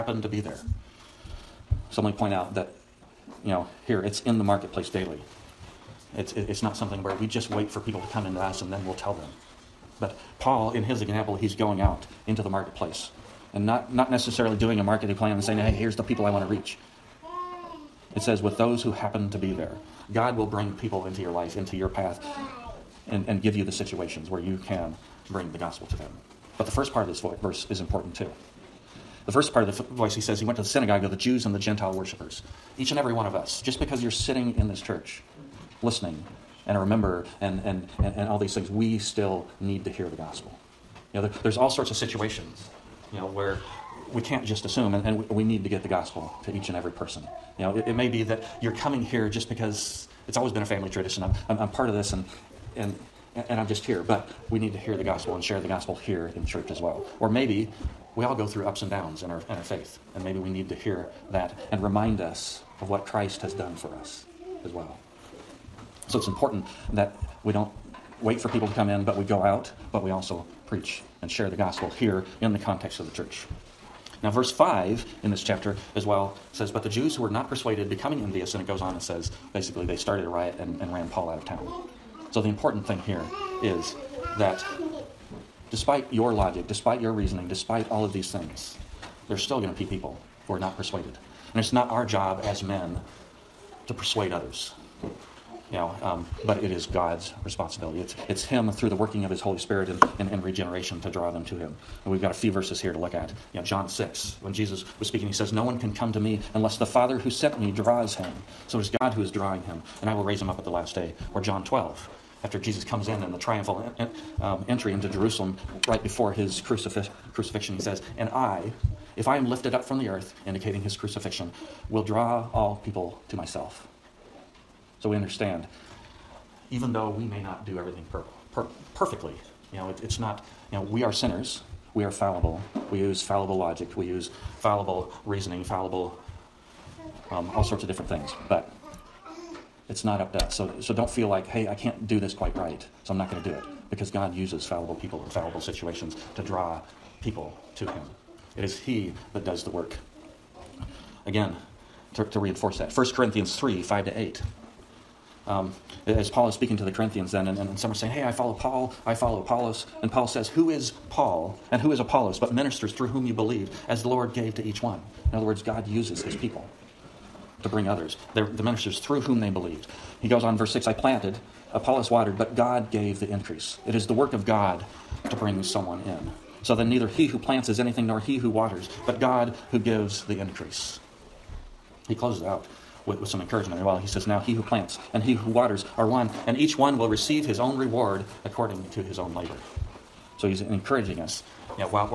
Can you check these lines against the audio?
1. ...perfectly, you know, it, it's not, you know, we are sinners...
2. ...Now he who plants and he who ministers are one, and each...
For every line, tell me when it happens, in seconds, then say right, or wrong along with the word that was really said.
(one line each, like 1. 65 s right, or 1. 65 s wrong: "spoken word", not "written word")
1. 128 s right
2. 184 s wrong: "waters", not "ministers".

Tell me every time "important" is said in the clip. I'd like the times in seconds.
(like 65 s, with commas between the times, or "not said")
27 s, 66 s, 82 s.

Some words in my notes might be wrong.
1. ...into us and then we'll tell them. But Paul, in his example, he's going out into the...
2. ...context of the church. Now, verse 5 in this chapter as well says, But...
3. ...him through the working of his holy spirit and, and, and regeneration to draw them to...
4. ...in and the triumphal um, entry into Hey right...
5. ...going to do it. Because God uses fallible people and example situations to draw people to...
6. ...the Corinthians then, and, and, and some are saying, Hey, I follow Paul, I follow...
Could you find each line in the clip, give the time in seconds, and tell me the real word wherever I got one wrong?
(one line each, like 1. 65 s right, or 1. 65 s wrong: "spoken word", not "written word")
1. 8 s right
2. 72 s right
3. 98 s right
4. 113 s wrong: "Jerusalem", not "Hey"
5. 143 s wrong: "fallible", not "example"
6. 156 s right.